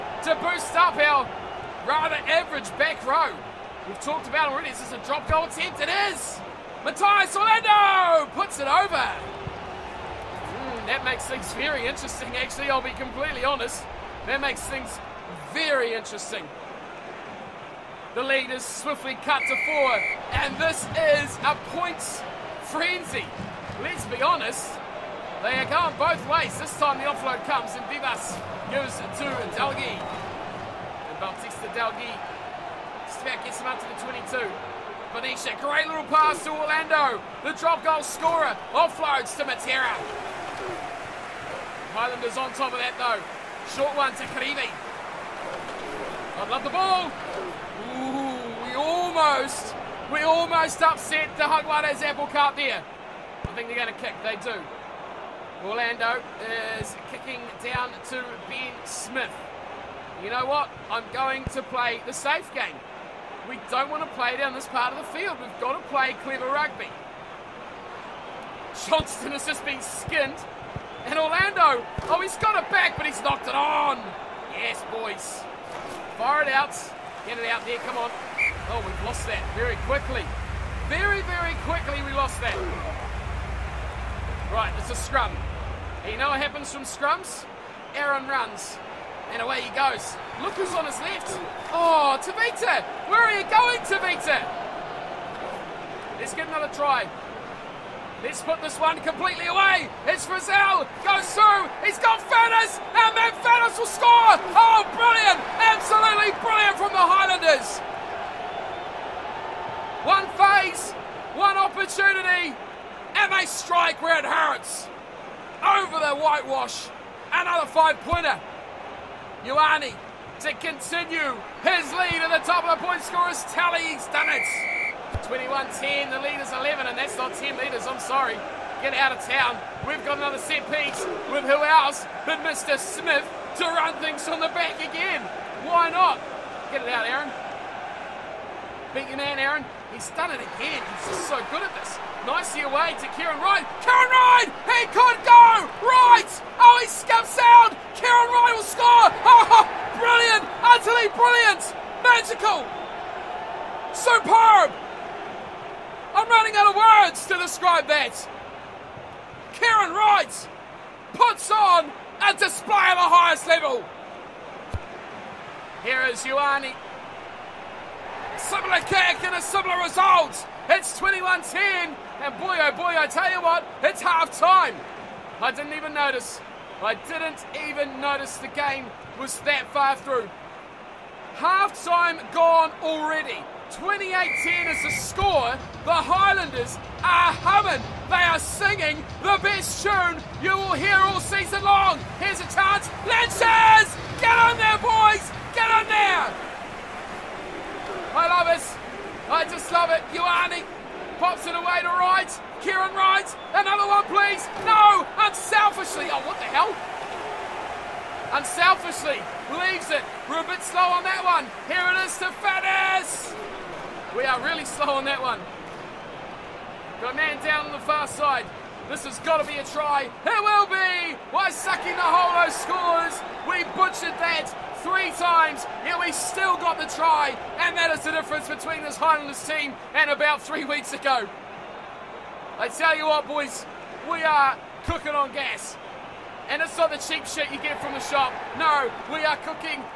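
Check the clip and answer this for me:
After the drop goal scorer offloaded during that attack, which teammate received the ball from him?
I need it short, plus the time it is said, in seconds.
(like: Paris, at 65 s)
Matera, at 39 s.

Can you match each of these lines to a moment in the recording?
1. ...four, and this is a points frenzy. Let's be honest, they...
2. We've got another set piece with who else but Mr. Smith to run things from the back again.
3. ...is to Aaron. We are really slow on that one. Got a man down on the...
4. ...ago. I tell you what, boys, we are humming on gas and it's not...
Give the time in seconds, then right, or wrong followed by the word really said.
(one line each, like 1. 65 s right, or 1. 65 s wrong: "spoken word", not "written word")
1. 19 s right
2. 129 s right
3. 212 s wrong: "Faddes", not "Aaron"
4. 230 s wrong: "cooking", not "humming".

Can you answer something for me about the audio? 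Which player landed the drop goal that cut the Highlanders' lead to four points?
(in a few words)
Matthias Orlando.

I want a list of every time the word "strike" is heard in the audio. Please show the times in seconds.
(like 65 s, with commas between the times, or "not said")
113 s.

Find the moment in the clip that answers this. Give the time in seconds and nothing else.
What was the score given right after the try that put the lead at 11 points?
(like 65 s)
125 s.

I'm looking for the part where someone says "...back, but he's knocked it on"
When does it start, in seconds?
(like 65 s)
72 s.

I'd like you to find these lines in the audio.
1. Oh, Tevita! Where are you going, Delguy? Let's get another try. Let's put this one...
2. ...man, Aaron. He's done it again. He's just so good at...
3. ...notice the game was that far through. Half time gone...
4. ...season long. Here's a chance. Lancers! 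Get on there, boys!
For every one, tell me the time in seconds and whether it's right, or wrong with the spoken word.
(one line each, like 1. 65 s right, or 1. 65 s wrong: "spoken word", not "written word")
1. 91 s wrong: "Tevita", not "Delguy"
2. 139 s right
3. 178 s right
4. 191 s right.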